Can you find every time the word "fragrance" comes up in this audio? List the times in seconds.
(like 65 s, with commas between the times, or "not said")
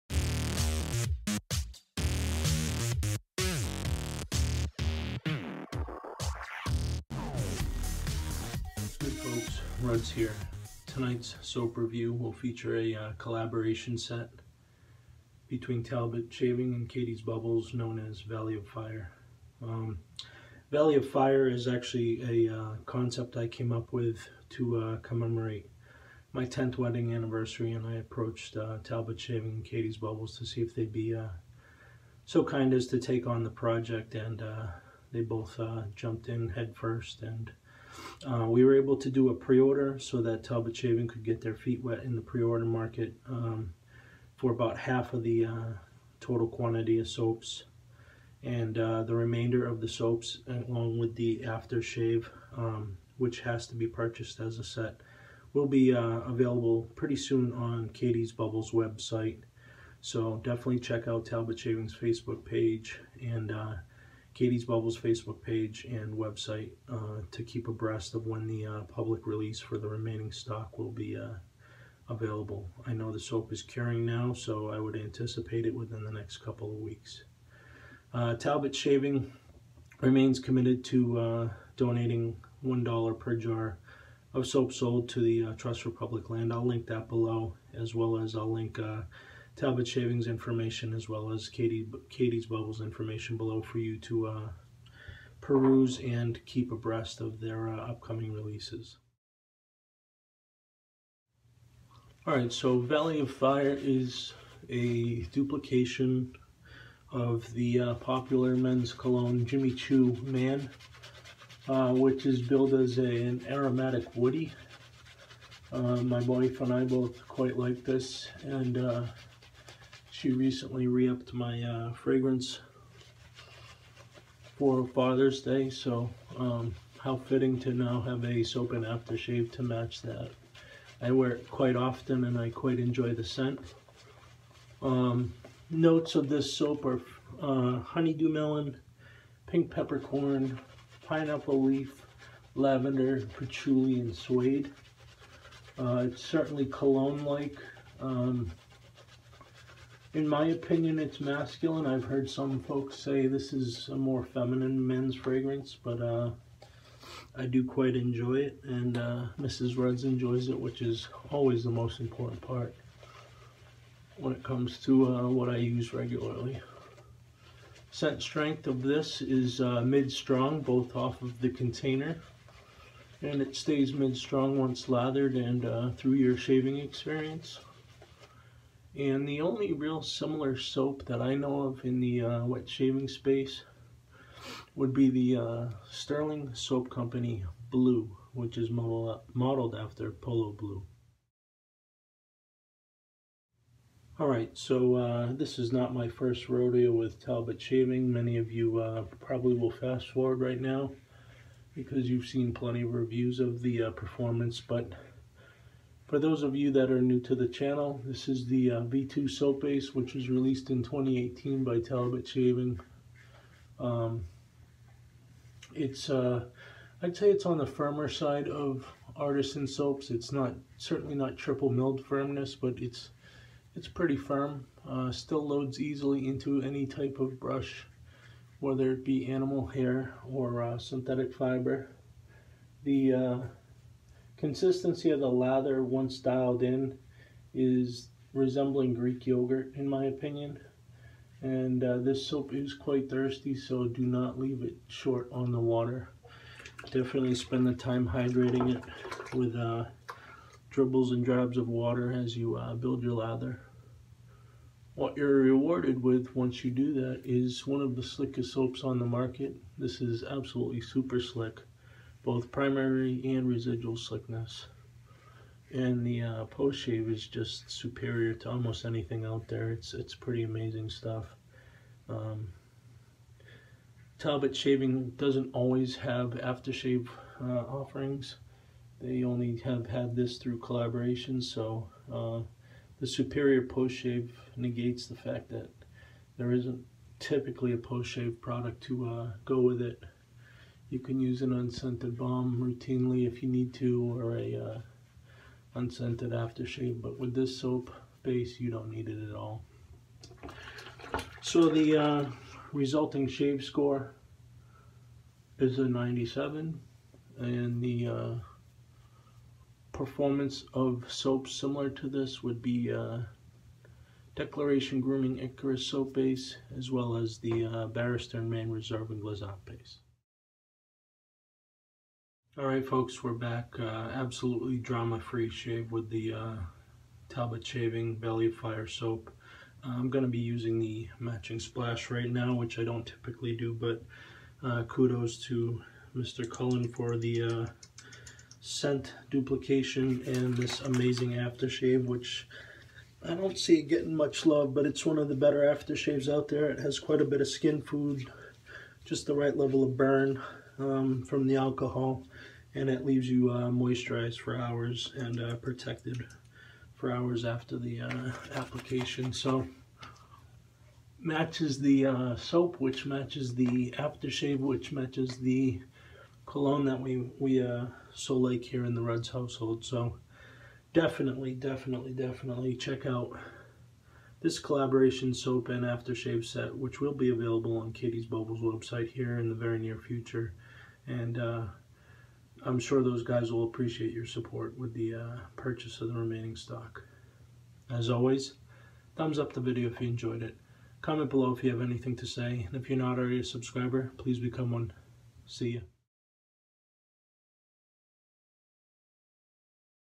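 121 s, 155 s.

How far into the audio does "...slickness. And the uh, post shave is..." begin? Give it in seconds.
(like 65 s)
263 s.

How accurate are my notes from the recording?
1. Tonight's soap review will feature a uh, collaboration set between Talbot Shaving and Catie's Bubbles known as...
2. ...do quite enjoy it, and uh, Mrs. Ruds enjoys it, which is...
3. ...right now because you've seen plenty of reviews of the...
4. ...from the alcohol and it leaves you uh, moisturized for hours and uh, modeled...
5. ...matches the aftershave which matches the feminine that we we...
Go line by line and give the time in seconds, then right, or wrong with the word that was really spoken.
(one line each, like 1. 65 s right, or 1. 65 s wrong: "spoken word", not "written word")
1. 10 s right
2. 157 s right
3. 200 s right
4. 351 s wrong: "protected", not "modeled"
5. 363 s wrong: "cologne", not "feminine".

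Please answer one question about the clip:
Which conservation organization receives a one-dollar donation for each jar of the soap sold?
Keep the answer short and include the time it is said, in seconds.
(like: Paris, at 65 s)
Trust for Public Land, at 85 s.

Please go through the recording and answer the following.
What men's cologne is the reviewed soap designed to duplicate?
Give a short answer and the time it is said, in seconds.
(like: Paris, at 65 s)
Jimmy Choo Man, at 109 s.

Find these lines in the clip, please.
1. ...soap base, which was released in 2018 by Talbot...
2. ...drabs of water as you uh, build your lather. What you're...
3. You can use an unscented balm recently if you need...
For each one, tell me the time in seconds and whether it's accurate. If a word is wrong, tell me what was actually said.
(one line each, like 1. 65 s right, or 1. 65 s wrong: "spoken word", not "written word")
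1. 209 s right
2. 251 s right
3. 290 s wrong: "routinely", not "recently".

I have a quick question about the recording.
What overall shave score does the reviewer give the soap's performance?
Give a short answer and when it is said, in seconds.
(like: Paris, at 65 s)
97, at 305 s.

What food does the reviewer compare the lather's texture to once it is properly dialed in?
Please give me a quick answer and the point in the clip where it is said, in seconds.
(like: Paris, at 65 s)
Greek yogurt, at 238 s.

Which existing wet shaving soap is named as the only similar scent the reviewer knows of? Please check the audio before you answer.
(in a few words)
Sterling Soap Company Blue.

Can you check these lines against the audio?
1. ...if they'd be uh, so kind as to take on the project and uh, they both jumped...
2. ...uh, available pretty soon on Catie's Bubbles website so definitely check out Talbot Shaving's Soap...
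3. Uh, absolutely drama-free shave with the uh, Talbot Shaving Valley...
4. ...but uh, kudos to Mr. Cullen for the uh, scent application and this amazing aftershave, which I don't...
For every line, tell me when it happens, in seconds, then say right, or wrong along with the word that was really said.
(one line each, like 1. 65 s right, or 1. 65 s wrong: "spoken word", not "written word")
1. 30 s right
2. 55 s wrong: "Facebook", not "Soap"
3. 323 s right
4. 333 s wrong: "duplication", not "application".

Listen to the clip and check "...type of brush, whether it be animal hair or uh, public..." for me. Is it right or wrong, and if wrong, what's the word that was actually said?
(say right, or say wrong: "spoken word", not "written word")
wrong: "synthetic", not "public".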